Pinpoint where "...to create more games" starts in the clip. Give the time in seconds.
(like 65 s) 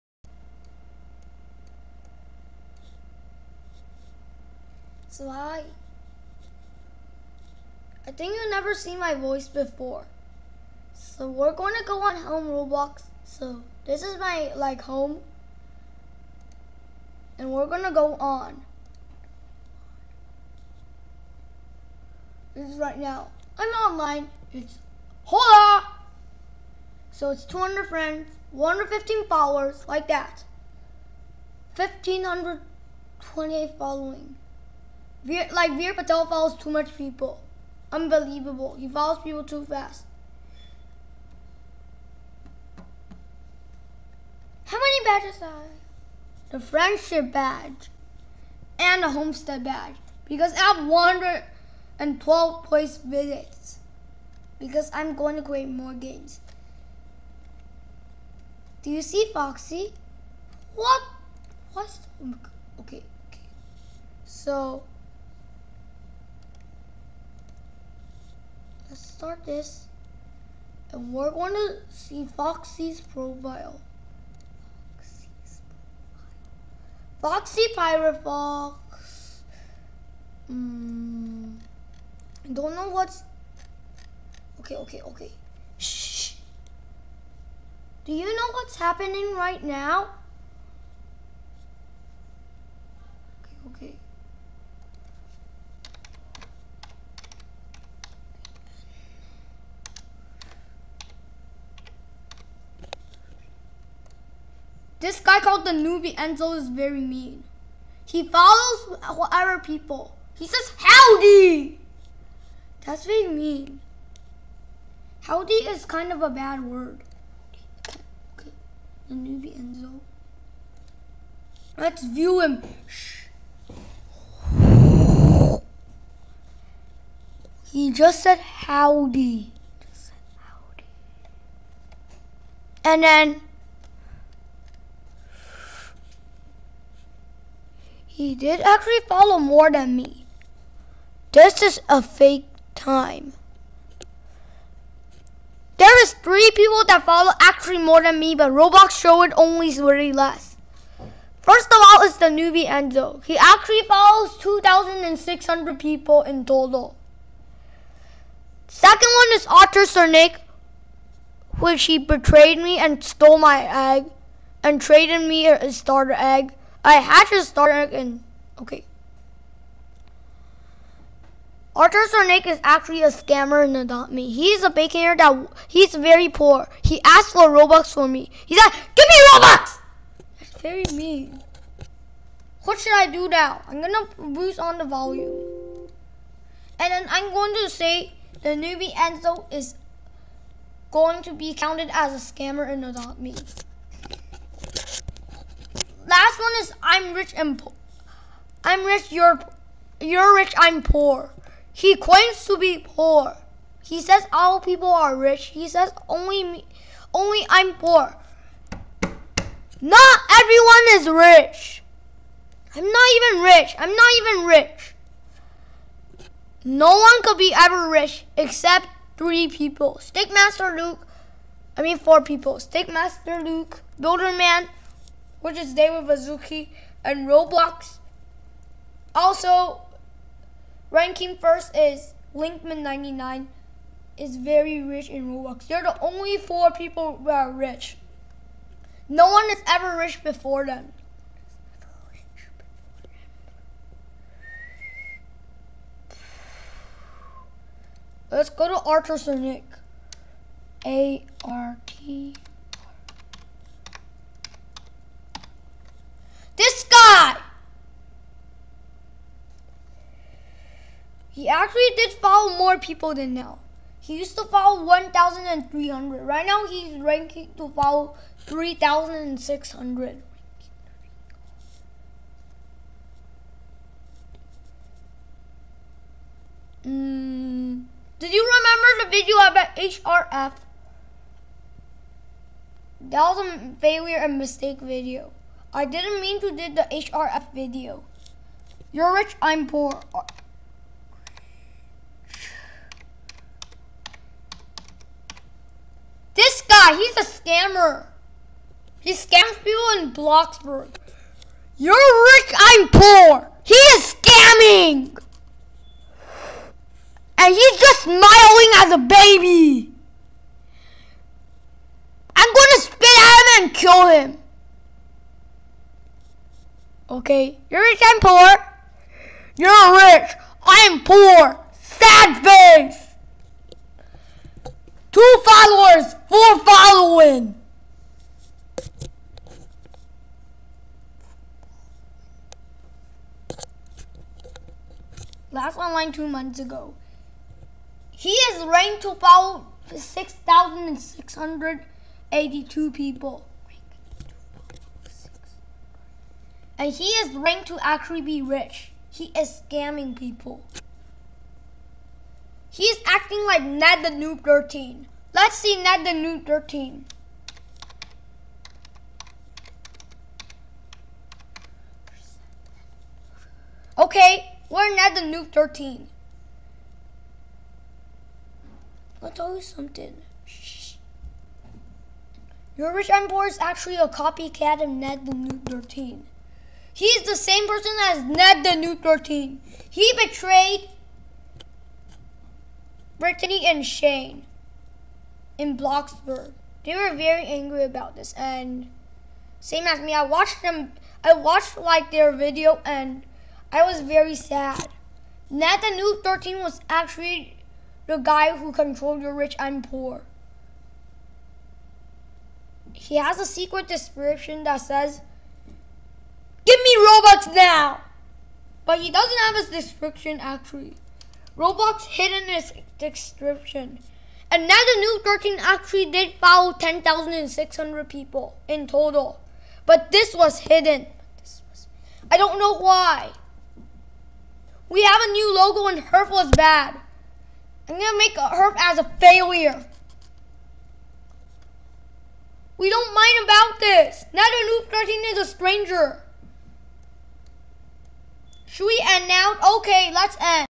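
55 s.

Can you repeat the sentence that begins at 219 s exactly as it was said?
Stickmaster Luke, I mean four people.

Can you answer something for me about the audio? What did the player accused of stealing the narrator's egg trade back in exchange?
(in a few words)
a starter egg.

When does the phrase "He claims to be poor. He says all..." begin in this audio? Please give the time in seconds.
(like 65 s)
201 s.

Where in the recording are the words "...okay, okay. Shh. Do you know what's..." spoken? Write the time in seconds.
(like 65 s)
84 s.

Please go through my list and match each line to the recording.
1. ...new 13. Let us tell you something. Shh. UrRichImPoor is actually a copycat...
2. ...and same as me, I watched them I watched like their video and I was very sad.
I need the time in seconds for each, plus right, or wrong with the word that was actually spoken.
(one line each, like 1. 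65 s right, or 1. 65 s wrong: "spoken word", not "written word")
1. 365 s right
2. 388 s right.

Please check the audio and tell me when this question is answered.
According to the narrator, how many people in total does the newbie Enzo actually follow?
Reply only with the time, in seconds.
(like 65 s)
154 s.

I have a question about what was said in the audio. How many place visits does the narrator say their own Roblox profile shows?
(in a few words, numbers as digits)
112.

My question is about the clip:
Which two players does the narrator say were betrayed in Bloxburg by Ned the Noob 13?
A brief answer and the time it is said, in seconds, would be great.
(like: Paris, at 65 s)
Brittany and Shane, at 383 s.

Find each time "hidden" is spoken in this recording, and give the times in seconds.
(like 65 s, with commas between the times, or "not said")
412 s, 420 s.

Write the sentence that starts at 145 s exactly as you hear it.
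There is three people that follow actually more than me, but Roblox showed it only really less.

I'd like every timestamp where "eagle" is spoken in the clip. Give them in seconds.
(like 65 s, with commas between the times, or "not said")
not said.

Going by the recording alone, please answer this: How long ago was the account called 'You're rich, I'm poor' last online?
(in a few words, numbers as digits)
two months ago.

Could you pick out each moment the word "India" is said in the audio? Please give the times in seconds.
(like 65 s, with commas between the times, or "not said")
not said.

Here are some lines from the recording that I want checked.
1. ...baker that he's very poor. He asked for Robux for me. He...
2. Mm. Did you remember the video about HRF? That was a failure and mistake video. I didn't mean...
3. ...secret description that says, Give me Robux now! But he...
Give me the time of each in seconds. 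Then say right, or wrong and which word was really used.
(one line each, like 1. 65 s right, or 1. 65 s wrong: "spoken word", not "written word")
1. 174 s right
2. 276 s right
3. 403 s right.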